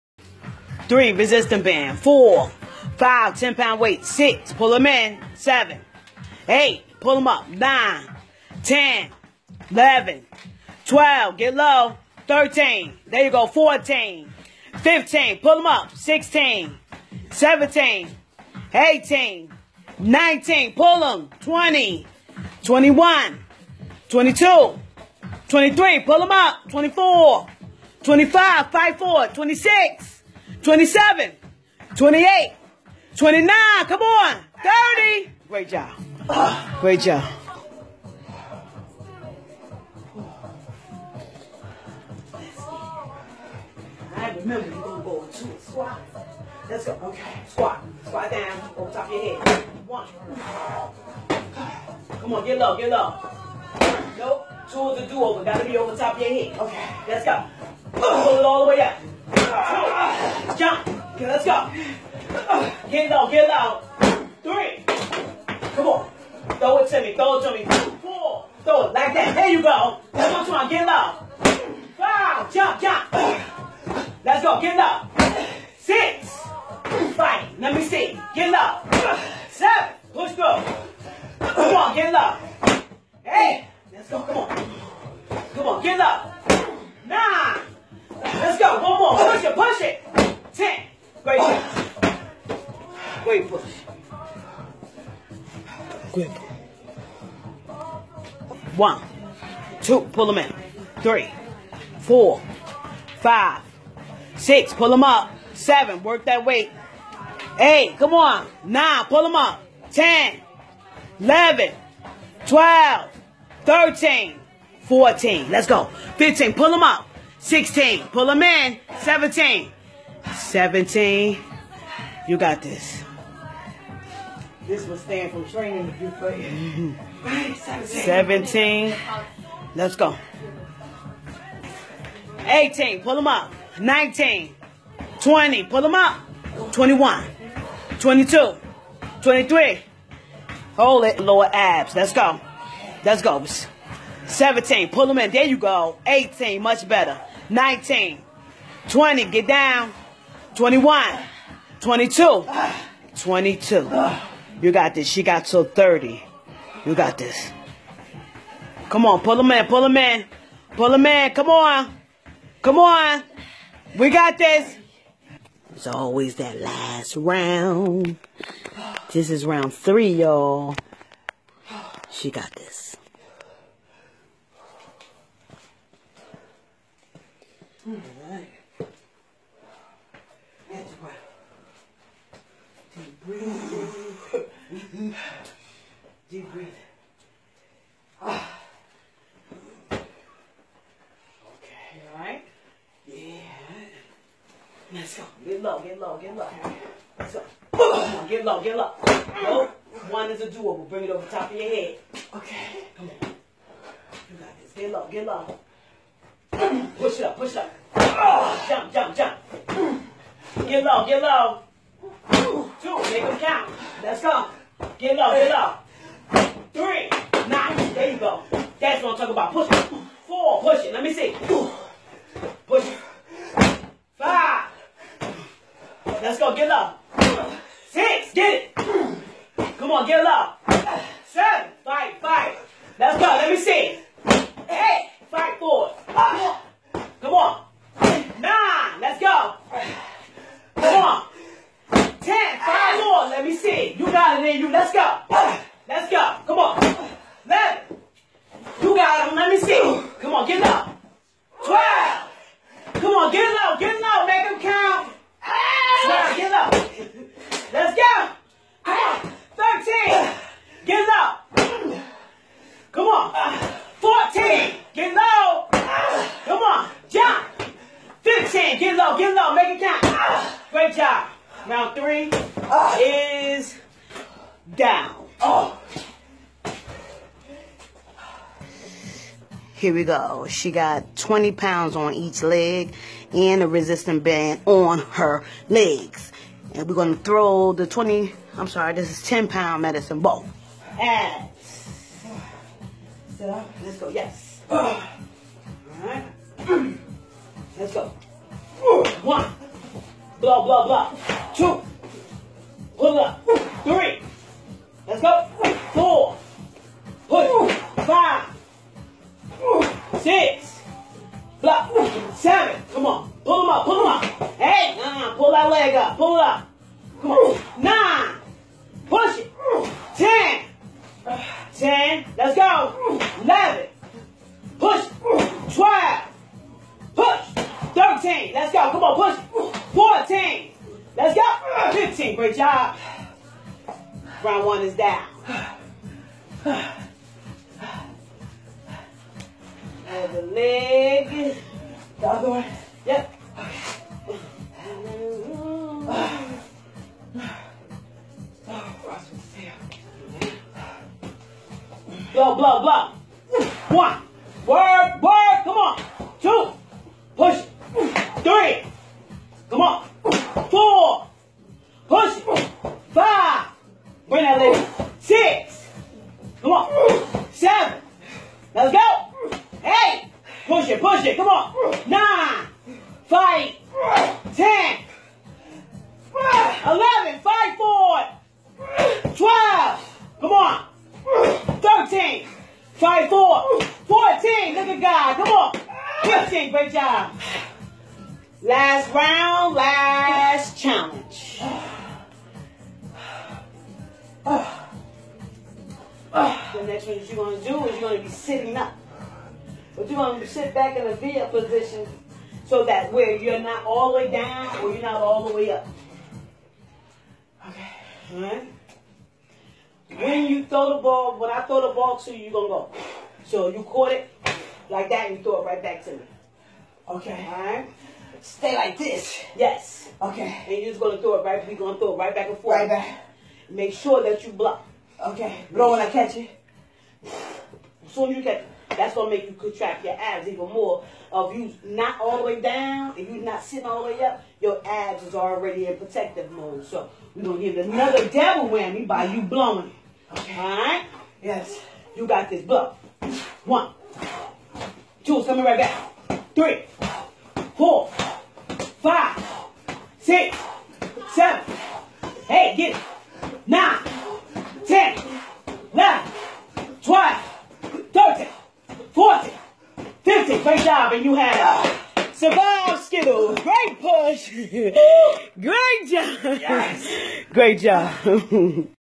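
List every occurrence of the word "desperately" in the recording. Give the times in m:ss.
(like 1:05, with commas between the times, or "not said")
not said.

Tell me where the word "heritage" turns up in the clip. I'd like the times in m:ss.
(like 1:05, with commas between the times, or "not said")
not said.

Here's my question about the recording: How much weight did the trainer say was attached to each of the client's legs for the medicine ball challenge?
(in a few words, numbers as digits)
20 pounds.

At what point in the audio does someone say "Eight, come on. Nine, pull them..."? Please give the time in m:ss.
1:47.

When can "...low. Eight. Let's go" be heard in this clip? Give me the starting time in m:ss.
1:22.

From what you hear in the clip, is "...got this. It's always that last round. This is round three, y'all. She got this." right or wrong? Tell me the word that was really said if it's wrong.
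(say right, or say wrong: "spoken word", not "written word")
right.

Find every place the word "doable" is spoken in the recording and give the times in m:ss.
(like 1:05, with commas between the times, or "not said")
3:20.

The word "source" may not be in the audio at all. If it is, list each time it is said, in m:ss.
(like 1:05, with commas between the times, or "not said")
not said.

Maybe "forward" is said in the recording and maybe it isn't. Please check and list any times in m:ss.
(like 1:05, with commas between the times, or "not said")
6:17, 6:23.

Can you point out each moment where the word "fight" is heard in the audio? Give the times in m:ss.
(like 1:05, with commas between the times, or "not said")
0:28, 1:17, 6:13, 6:17, 6:22.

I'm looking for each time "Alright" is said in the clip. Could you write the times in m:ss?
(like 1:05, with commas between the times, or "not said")
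7:20.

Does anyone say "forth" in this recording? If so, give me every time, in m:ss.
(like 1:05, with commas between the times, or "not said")
7:02.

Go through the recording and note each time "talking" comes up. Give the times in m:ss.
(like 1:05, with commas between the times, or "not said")
3:39.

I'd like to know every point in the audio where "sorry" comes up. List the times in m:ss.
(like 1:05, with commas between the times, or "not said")
4:48.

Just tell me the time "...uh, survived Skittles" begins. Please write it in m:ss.
7:41.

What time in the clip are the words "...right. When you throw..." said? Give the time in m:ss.
6:48.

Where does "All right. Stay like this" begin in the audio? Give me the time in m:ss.
6:57.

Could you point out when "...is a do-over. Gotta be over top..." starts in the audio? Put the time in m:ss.
0:54.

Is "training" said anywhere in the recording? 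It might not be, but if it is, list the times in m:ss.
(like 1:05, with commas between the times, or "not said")
2:05.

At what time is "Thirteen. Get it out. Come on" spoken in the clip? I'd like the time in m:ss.
4:19.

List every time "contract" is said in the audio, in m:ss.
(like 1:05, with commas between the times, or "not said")
7:09.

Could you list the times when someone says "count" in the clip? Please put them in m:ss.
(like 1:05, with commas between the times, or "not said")
3:33, 4:14, 4:29.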